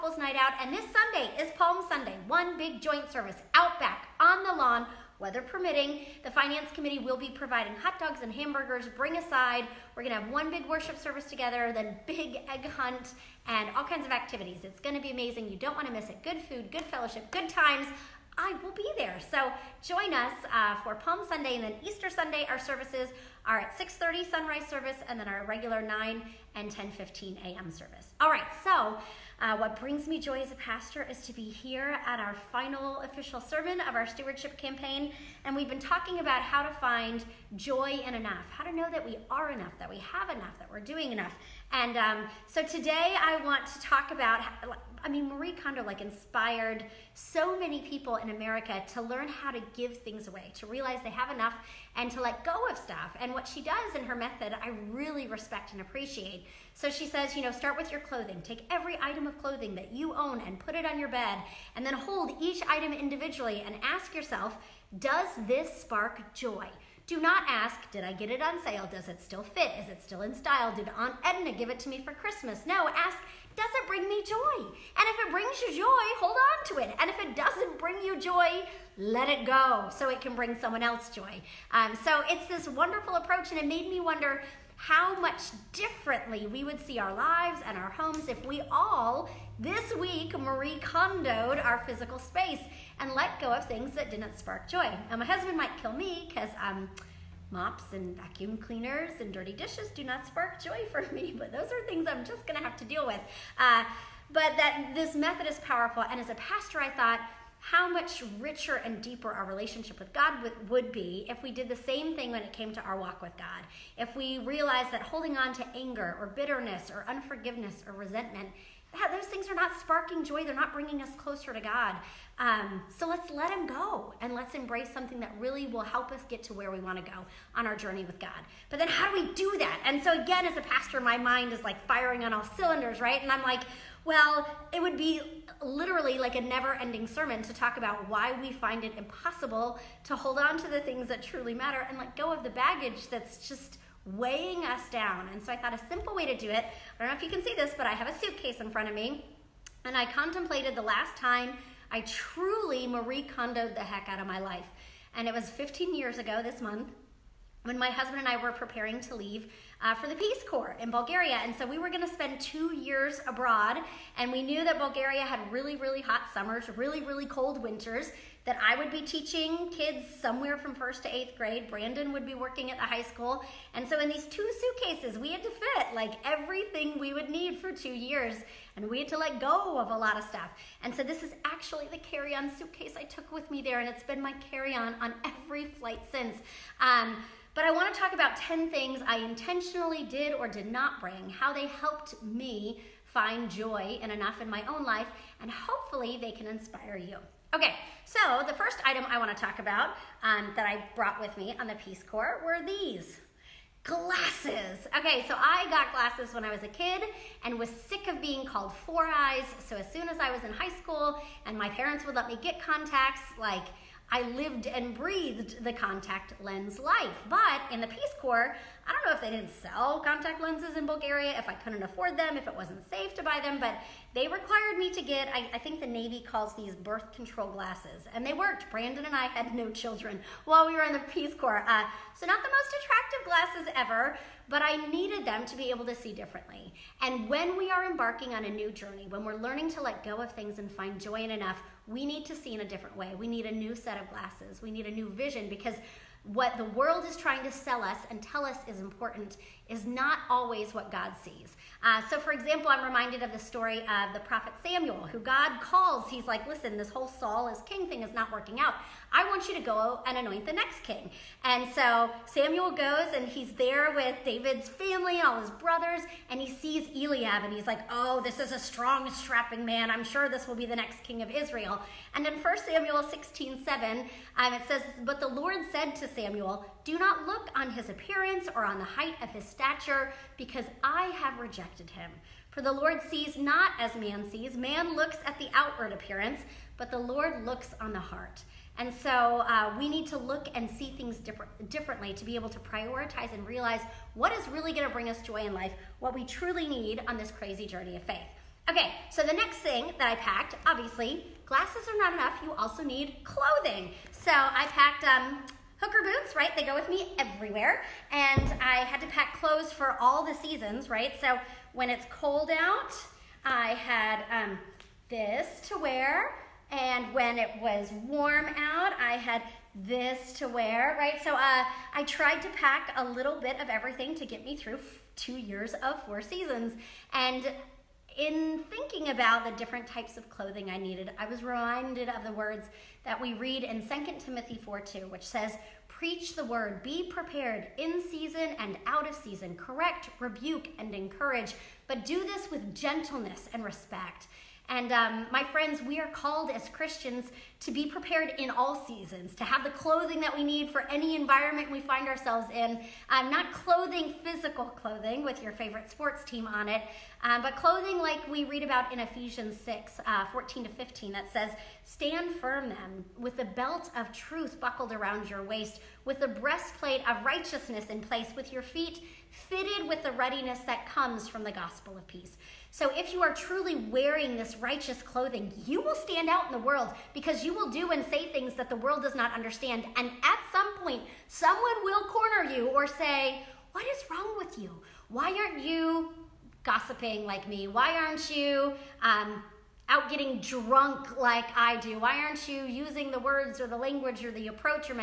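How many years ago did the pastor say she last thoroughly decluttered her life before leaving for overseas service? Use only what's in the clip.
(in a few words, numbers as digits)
15.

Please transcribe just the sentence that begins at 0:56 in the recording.
So she says, you know, start with your clothing.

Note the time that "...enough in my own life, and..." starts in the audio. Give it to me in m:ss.
3:14.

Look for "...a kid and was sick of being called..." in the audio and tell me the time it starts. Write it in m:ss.
3:26.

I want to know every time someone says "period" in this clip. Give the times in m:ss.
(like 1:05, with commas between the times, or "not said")
not said.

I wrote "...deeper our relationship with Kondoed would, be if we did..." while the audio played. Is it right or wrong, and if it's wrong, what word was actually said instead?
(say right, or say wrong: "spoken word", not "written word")
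wrong: "God", not "Kondoed".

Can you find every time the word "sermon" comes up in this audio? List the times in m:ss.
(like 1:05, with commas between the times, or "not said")
0:33, 2:17.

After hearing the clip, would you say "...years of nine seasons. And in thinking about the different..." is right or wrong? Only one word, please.
wrong.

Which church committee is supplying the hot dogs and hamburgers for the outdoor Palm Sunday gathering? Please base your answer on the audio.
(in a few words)
Finance Committee.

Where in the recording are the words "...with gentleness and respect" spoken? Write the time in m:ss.
5:42.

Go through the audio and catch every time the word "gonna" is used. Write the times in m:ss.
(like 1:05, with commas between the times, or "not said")
0:10, 0:14, 2:41.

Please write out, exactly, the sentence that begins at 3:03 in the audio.
And it's been my carry-on on every flight since.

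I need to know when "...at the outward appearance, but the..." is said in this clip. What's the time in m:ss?
4:45.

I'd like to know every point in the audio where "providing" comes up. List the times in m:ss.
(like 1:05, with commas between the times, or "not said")
0:07.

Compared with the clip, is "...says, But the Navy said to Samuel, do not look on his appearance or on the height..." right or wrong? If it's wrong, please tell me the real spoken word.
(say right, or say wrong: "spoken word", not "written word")
wrong: "Lord", not "Navy".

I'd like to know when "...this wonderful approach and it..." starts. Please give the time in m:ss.
1:22.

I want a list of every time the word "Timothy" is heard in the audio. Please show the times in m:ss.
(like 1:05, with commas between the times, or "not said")
5:34.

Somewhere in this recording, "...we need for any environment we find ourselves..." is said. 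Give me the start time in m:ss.
5:50.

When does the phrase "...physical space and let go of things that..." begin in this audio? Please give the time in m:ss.
1:31.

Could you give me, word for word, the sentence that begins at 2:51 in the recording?
Brandon would be working at the high school.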